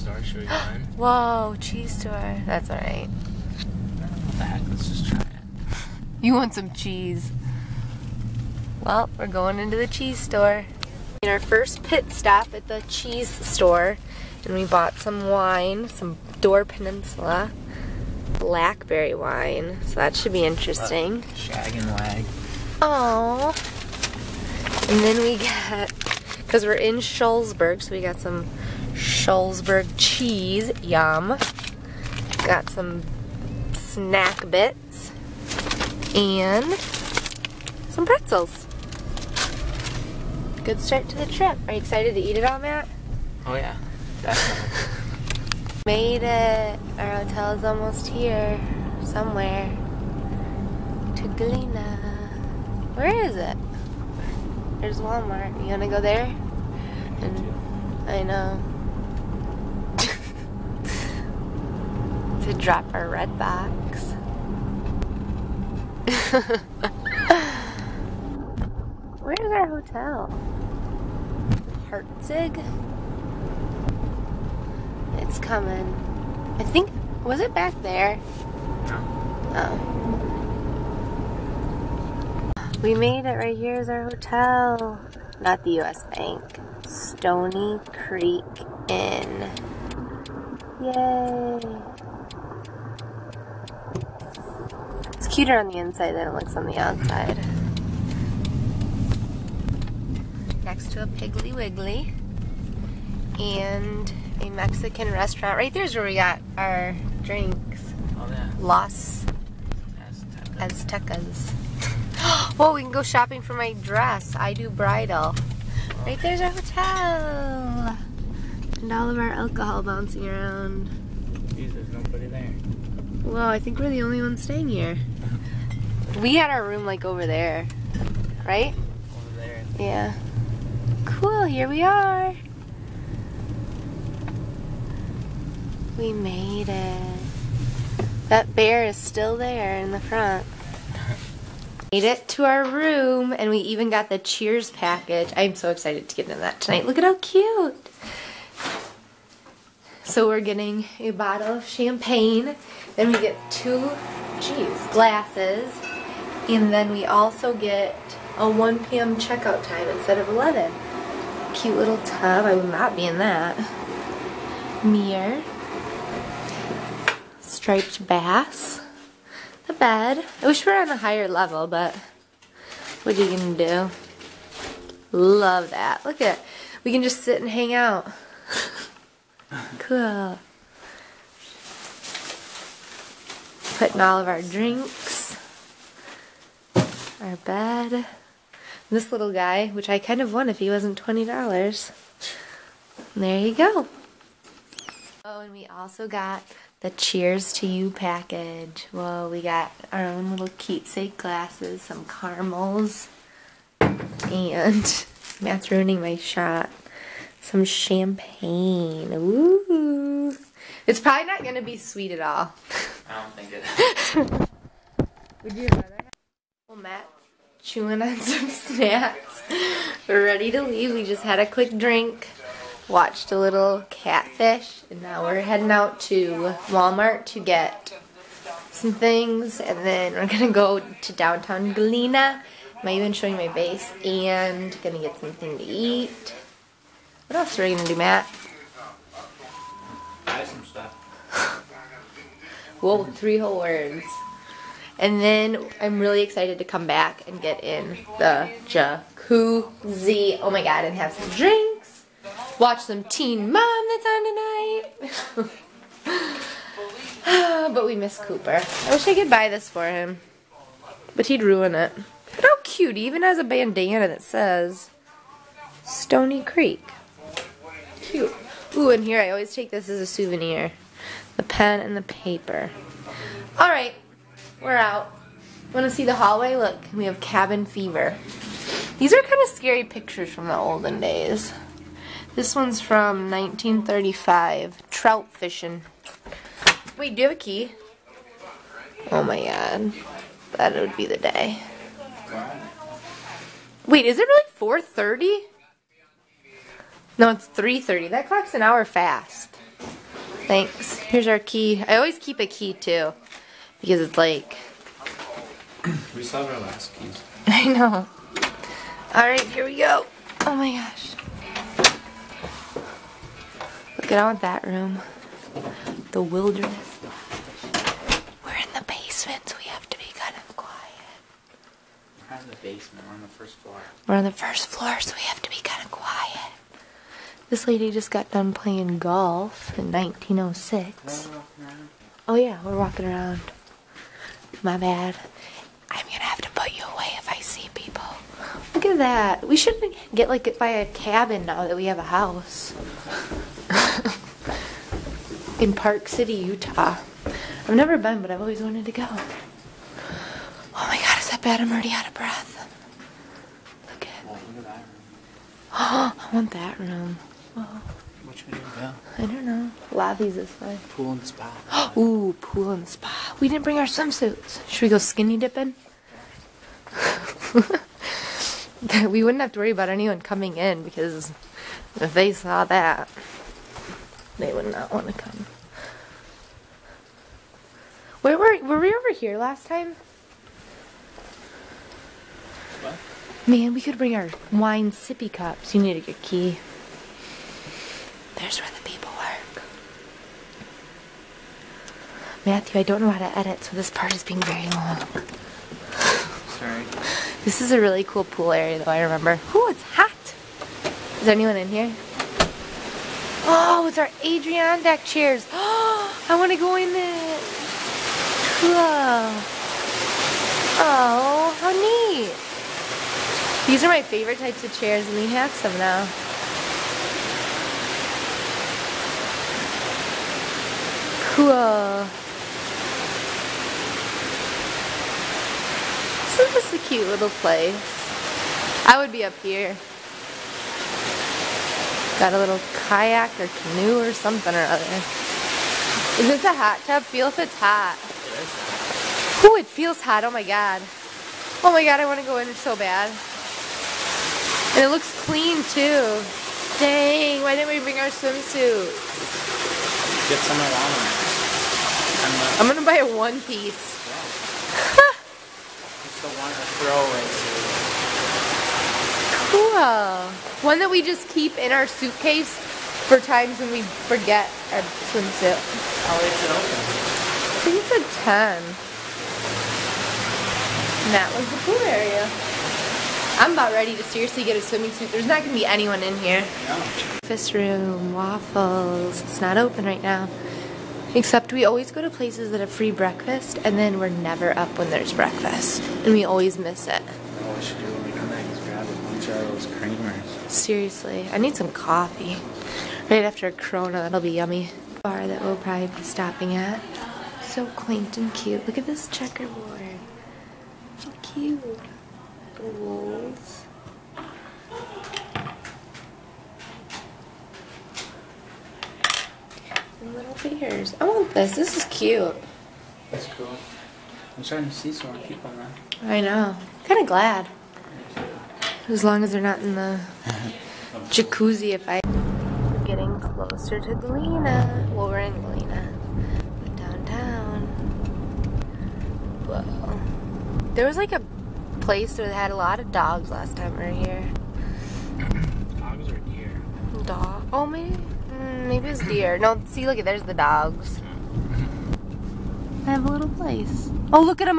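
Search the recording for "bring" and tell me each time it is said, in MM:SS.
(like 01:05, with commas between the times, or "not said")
06:03, 06:23, 07:27.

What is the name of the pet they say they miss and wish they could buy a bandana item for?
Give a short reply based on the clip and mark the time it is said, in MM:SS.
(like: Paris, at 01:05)
Cooper, at 04:18.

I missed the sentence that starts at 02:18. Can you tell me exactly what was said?
That bear is still there in the front.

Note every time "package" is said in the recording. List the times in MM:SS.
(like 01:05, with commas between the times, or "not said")
02:24, 03:17.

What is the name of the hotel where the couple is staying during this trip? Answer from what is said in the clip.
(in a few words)
Stoney Creek Inn.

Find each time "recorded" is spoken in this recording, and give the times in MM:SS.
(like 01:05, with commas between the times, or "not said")
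not said.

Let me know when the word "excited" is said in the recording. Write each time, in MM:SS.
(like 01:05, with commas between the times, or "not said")
00:41, 02:25, 04:06.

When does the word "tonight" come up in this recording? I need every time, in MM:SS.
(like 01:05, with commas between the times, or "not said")
02:26, 04:16.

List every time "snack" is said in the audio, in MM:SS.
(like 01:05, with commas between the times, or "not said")
00:33, 03:38.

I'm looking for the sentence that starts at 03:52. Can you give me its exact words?
i even showing my base, and gonna get something to eat.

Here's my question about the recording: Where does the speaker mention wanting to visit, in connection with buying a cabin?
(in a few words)
Park City, Utah.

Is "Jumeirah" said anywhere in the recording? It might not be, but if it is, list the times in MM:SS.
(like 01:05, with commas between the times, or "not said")
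not said.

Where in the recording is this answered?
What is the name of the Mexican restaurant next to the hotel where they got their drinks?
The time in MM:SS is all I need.
01:48.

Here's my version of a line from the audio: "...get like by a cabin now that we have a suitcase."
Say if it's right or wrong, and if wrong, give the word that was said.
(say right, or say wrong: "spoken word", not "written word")
wrong: "house", not "suitcase".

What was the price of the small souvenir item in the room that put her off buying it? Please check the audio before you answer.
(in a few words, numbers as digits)
$20.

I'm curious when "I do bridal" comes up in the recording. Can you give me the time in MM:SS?
01:54.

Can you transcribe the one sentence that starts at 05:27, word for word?
This lady just got done playing golf in 1906.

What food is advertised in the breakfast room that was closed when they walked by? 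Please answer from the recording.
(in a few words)
Waffles.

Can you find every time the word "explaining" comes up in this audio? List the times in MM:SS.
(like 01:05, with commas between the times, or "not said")
not said.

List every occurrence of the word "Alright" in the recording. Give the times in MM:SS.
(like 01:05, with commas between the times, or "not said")
04:33, 05:09.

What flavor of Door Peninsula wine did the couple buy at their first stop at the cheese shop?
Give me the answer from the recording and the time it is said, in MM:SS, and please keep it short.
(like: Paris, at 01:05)
Blackberry, at 00:18.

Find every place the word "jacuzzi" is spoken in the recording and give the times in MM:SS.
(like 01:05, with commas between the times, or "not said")
04:08, 08:41.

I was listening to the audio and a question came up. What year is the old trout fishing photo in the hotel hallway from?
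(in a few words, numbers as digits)
1935.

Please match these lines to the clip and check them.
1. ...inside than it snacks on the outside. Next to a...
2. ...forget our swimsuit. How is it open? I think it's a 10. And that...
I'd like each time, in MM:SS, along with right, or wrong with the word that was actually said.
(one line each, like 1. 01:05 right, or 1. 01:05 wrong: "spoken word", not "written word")
1. 01:35 wrong: "looks", not "snacks"
2. 07:44 right.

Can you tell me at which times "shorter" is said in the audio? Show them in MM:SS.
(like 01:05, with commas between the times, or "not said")
not said.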